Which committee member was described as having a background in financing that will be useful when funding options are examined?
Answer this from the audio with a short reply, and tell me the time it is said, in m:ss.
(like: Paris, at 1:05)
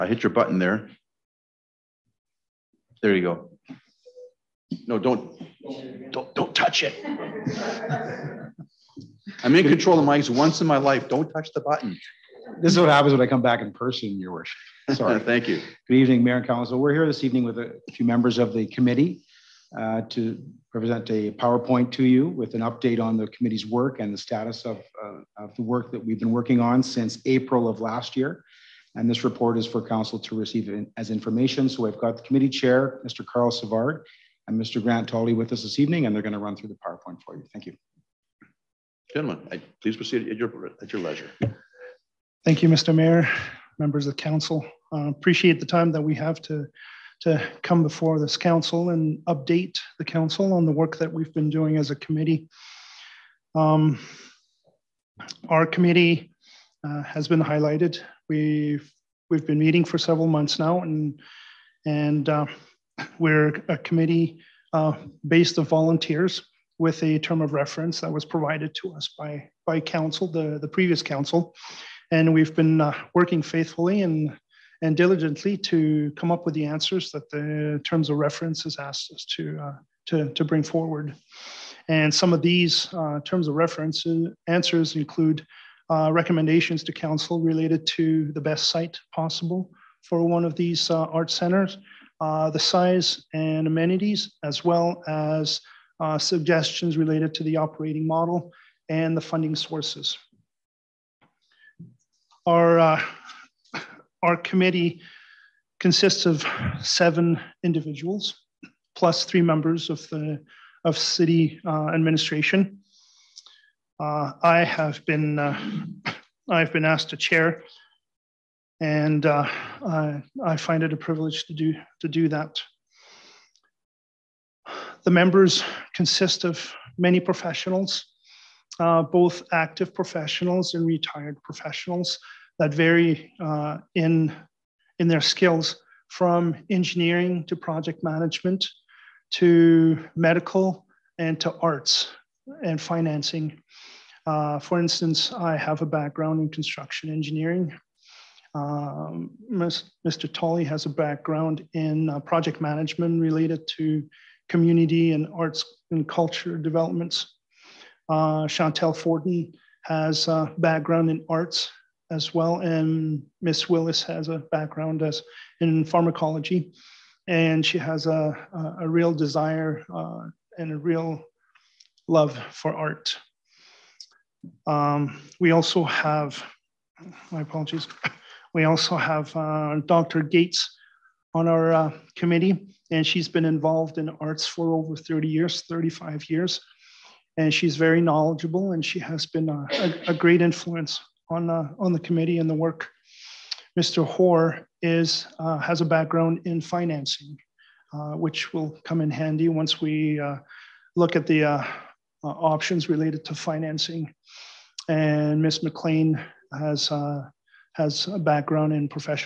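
Mr. Hoare, at 3:13.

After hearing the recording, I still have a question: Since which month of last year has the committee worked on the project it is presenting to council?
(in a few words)
April.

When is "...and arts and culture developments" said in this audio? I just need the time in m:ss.
2:35.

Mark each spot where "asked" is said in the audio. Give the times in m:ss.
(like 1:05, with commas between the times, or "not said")
1:18, 1:56.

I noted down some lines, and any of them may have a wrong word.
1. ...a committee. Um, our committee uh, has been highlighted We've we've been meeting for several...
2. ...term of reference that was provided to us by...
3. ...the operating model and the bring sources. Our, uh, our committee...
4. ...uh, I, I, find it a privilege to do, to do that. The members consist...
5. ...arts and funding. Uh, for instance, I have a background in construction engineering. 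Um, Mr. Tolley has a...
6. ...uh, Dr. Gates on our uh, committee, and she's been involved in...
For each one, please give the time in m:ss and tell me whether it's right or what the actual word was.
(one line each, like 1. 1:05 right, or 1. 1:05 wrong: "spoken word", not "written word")
1. 0:51 right
2. 1:07 right
3. 1:37 wrong: "funding", not "bring"
4. 1:59 right
5. 2:21 wrong: "financing", not "funding"
6. 2:59 right.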